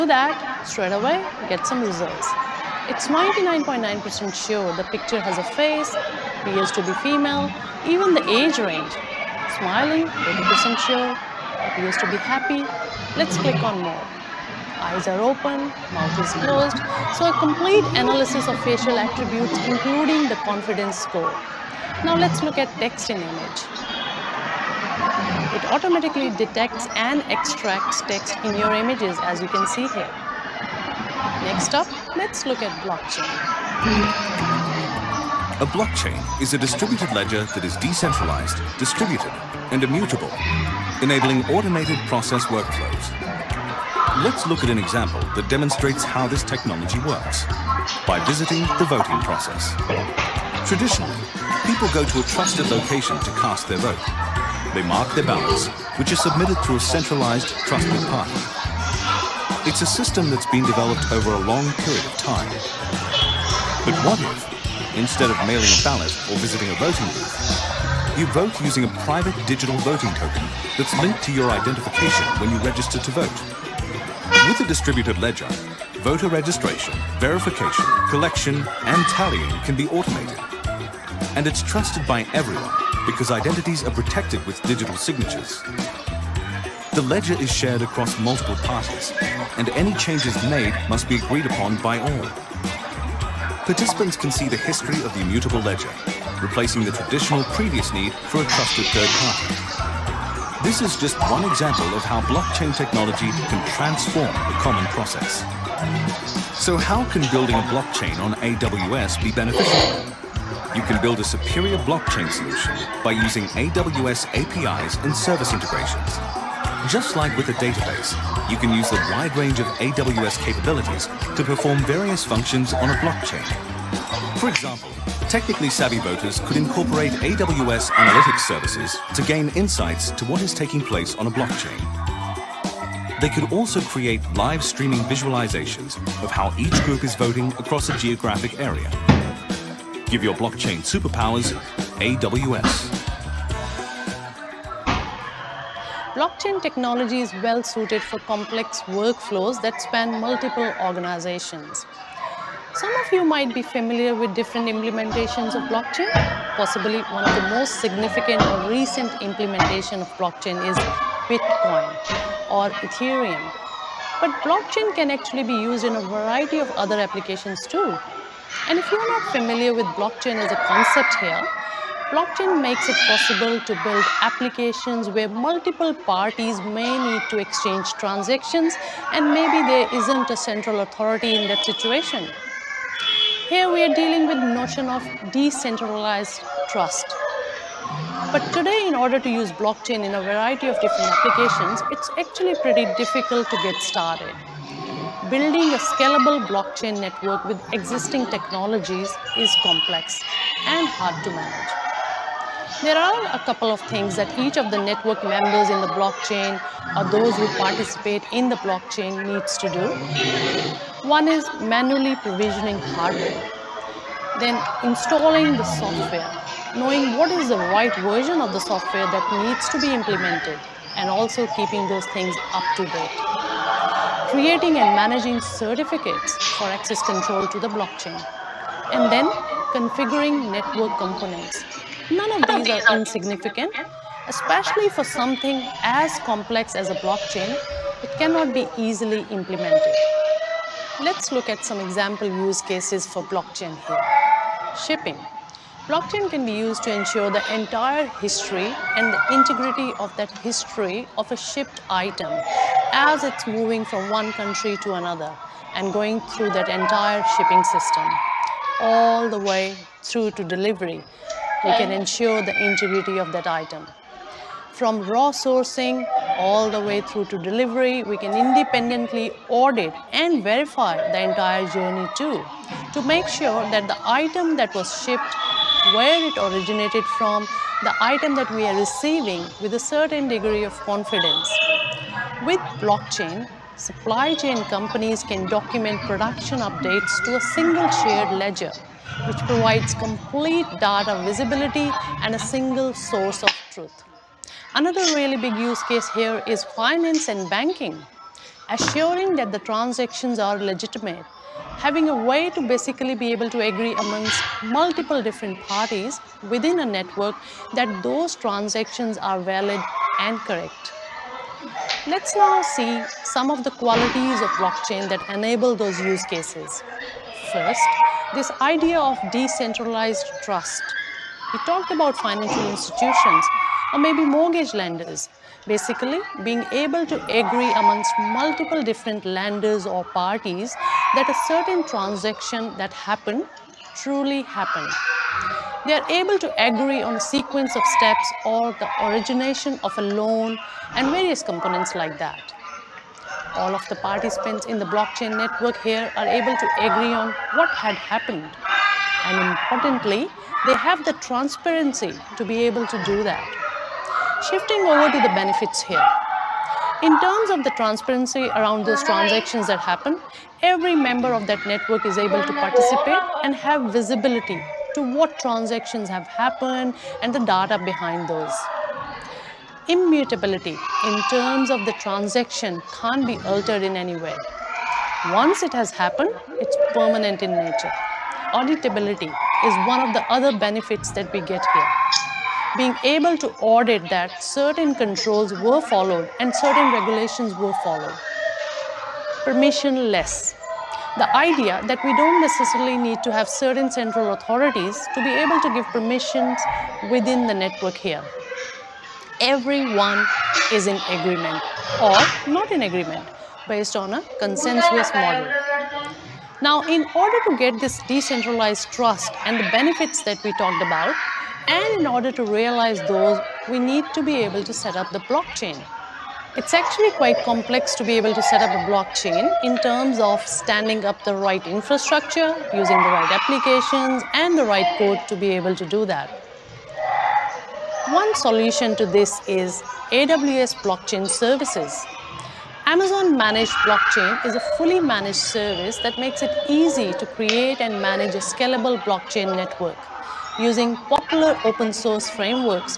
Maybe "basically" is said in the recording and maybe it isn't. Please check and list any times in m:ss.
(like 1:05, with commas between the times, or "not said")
5:02, 5:25.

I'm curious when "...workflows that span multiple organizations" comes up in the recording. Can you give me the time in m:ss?
2:28.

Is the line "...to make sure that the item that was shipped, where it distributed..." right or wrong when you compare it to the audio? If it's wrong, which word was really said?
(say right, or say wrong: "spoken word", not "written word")
wrong: "originated", not "distributed".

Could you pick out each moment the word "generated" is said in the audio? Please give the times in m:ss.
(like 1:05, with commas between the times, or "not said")
not said.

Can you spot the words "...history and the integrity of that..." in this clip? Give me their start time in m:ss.
4:08.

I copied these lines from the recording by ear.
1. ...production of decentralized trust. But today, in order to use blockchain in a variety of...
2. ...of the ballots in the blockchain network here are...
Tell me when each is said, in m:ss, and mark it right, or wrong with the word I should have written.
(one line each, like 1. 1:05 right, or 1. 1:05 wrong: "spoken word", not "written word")
1. 3:04 wrong: "notion", not "production"
2. 5:43 wrong: "participants", not "ballots".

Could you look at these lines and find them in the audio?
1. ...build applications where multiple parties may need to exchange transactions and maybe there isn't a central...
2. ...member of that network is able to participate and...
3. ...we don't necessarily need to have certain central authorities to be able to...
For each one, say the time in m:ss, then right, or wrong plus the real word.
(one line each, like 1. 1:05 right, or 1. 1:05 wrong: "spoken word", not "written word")
1. 2:53 right
2. 6:00 right
3. 6:32 right.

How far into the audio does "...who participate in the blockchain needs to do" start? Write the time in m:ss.
3:27.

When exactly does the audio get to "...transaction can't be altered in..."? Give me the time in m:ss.
6:12.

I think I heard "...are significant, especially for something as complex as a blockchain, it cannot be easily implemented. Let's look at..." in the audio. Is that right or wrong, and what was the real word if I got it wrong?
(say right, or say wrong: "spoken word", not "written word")
wrong: "insignificant", not "significant".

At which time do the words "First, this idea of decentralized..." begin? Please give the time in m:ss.
5:17.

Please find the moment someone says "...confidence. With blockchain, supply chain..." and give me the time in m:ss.
4:40.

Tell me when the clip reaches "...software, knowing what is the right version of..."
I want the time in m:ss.
3:35.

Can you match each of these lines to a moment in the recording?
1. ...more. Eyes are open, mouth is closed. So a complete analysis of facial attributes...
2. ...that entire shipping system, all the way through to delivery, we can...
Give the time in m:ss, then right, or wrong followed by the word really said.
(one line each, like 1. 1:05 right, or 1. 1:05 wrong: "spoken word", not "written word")
1. 0:13 right
2. 4:16 right.